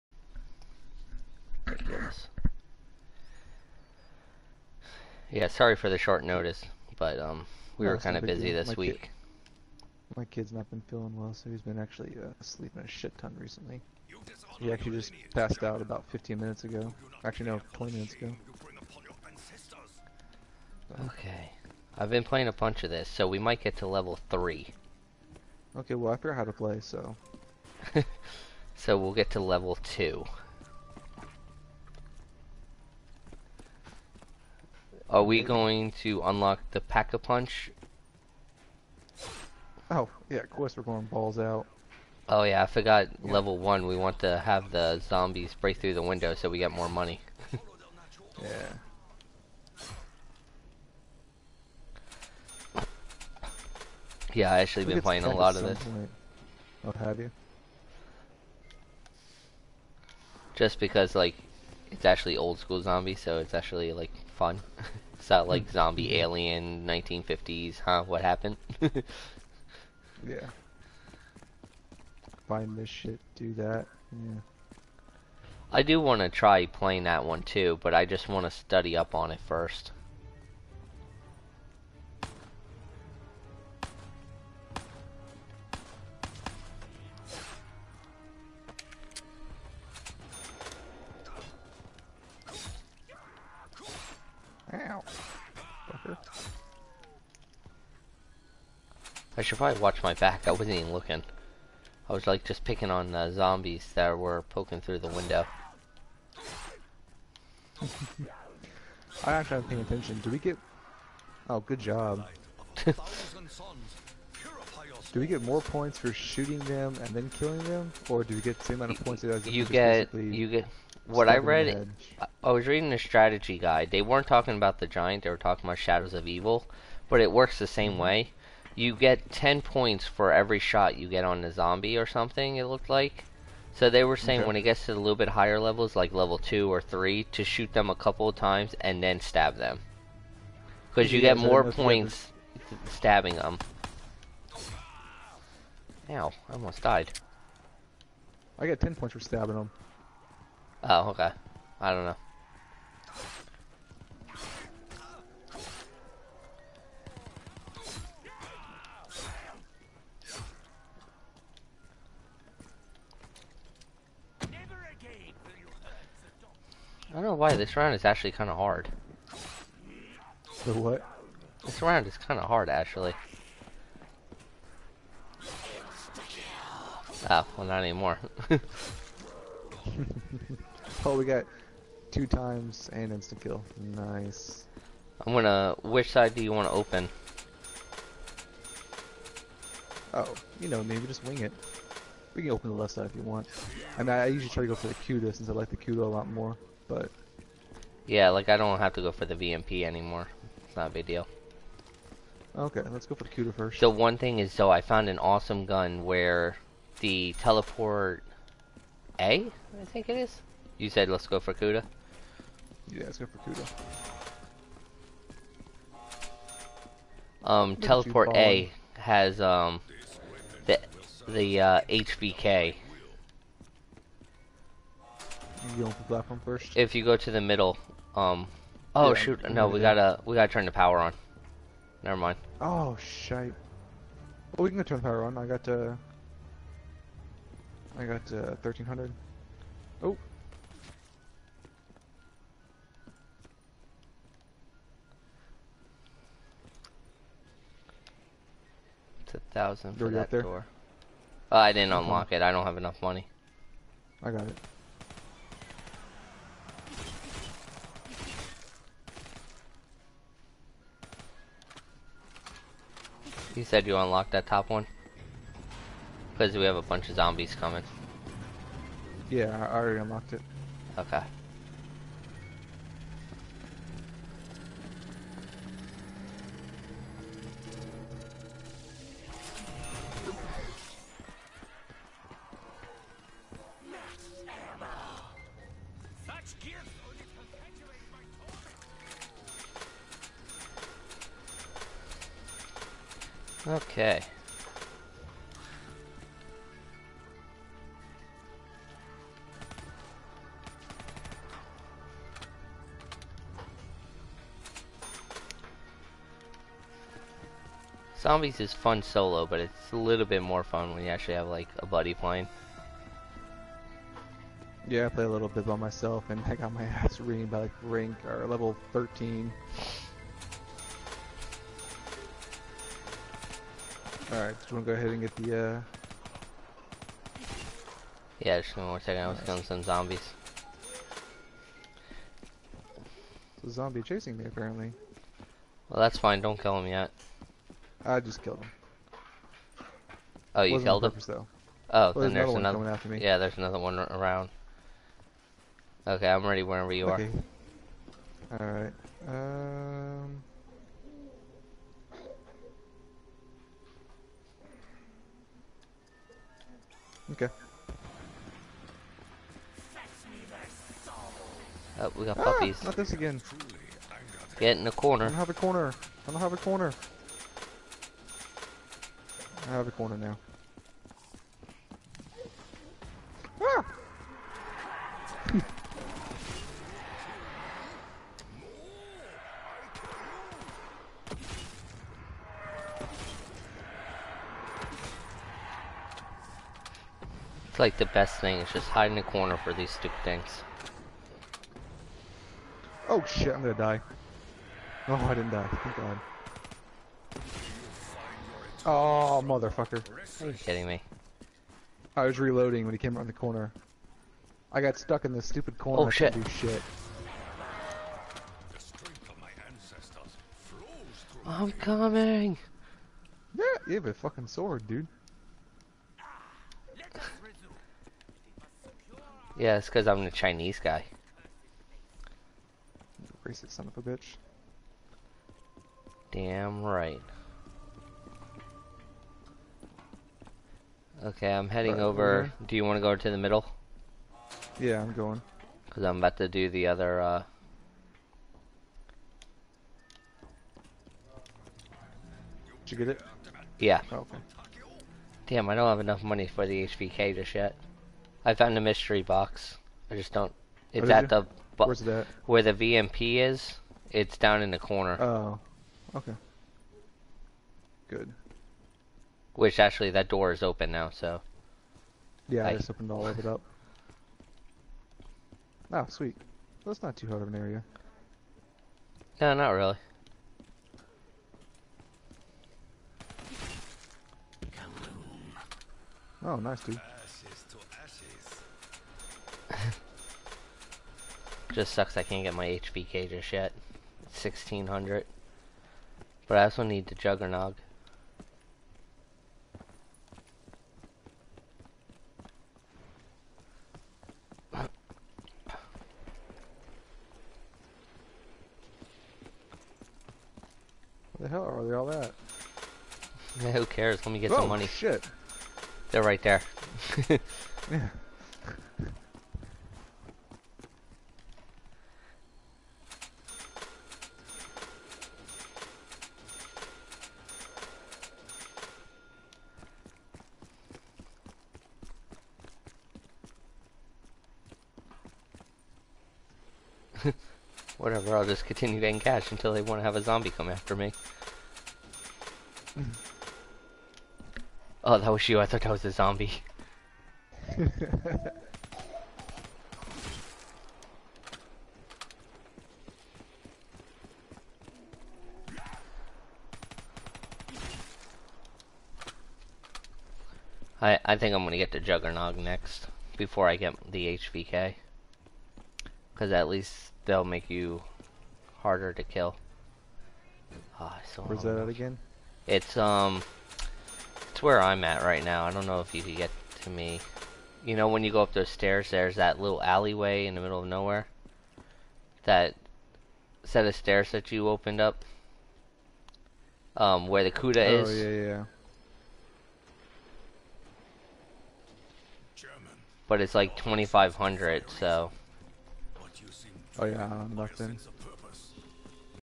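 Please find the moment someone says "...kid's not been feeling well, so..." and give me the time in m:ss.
0:10.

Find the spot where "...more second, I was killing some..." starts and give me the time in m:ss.
5:28.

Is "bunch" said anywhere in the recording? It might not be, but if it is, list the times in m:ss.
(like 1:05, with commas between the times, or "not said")
0:22, 4:26.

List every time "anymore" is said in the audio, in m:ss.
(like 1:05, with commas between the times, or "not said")
2:57, 3:19.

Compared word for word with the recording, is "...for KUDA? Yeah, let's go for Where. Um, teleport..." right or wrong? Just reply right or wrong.
wrong.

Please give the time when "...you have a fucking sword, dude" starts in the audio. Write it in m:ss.
6:53.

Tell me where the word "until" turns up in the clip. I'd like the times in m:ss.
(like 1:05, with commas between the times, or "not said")
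8:49.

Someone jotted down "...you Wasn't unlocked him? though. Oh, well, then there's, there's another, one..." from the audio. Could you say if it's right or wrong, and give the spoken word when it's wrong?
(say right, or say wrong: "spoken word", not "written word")
wrong: "killed", not "unlocked".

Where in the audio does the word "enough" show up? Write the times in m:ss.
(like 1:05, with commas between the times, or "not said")
4:12, 7:25.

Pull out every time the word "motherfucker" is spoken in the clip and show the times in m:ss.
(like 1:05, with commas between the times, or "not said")
6:39.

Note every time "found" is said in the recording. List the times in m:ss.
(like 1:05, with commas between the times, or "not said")
3:24, 7:28.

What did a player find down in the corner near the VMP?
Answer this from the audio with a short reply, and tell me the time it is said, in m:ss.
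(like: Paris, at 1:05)
Mystery box, at 7:28.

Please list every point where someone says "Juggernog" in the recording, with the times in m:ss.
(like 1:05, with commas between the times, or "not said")
8:07, 9:11.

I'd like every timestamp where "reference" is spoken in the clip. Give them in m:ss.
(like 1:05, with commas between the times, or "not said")
not said.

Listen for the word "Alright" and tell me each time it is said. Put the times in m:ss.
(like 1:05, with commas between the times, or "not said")
5:24, 5:48.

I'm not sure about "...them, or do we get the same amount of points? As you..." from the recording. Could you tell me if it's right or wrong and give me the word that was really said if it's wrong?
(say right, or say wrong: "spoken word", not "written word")
right.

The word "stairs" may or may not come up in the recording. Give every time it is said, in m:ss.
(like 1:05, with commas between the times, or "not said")
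9:28, 9:33.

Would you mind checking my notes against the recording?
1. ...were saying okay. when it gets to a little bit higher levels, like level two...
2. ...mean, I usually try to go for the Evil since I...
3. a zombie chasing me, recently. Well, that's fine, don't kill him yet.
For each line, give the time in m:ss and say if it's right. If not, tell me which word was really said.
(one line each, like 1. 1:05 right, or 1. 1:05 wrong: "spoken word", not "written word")
1. 2:14 right
2. 3:14 wrong: "KUDA", not "Evil"
3. 5:33 wrong: "apparently", not "recently".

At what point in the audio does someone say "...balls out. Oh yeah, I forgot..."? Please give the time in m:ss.
0:41.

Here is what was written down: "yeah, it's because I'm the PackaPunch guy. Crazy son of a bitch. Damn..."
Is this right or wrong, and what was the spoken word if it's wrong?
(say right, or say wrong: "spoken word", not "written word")
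wrong: "Chinese", not "PackaPunch".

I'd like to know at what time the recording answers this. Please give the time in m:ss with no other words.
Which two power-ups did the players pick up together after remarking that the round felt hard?
3:02.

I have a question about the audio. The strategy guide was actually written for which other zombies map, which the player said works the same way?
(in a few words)
Shadows of Evil.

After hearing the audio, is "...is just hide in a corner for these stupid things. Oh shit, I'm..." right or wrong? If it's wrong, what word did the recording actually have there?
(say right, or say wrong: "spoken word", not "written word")
right.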